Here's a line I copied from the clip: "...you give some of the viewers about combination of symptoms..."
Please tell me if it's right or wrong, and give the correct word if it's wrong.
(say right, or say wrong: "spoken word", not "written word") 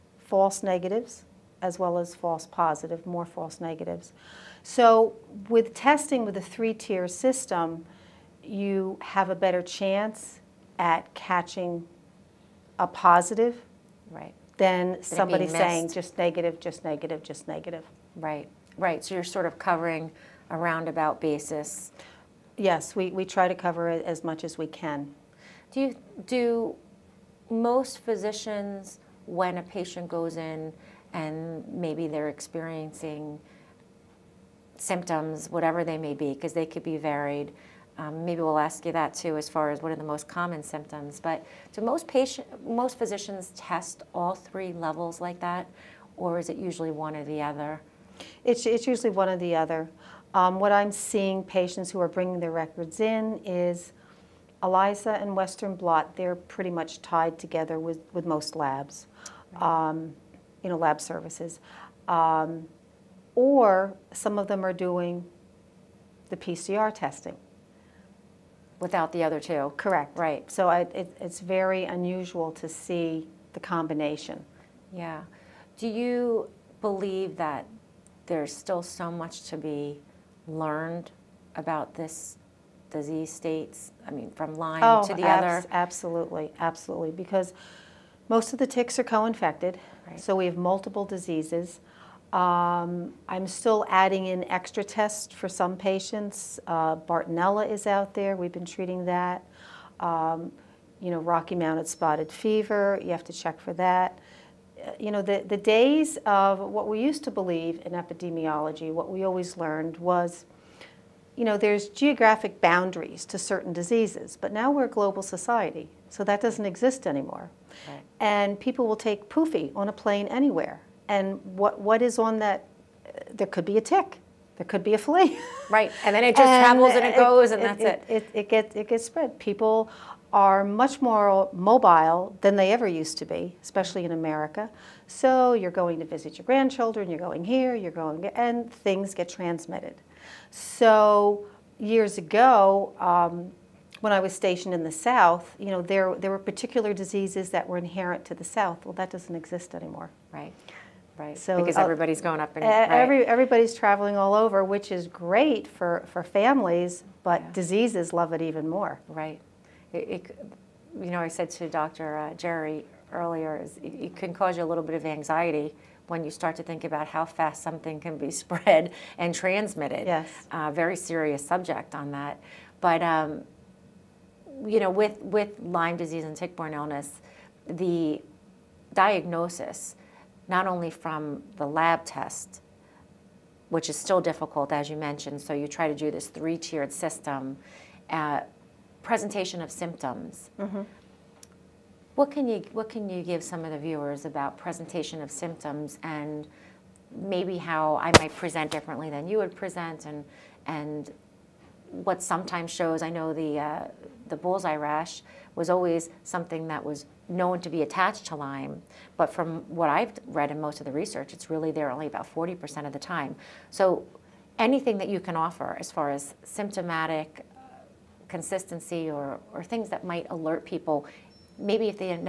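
wrong: "presentation", not "combination".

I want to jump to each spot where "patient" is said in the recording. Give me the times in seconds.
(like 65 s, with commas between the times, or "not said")
29 s, 42 s, 51 s, 95 s.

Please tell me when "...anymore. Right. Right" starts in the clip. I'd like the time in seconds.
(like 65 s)
149 s.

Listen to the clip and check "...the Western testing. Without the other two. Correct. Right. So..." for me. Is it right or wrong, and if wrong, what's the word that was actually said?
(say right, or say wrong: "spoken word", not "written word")
wrong: "PCR", not "Western".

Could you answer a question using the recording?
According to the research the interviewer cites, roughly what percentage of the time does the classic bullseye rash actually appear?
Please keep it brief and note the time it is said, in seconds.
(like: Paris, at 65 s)
40%, at 212 s.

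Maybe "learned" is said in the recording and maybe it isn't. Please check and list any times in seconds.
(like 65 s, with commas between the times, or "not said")
80 s, 109 s.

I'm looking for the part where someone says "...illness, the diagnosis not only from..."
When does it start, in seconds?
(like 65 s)
176 s.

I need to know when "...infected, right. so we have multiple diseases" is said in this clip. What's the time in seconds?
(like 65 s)
89 s.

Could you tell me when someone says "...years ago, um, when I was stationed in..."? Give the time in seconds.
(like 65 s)
141 s.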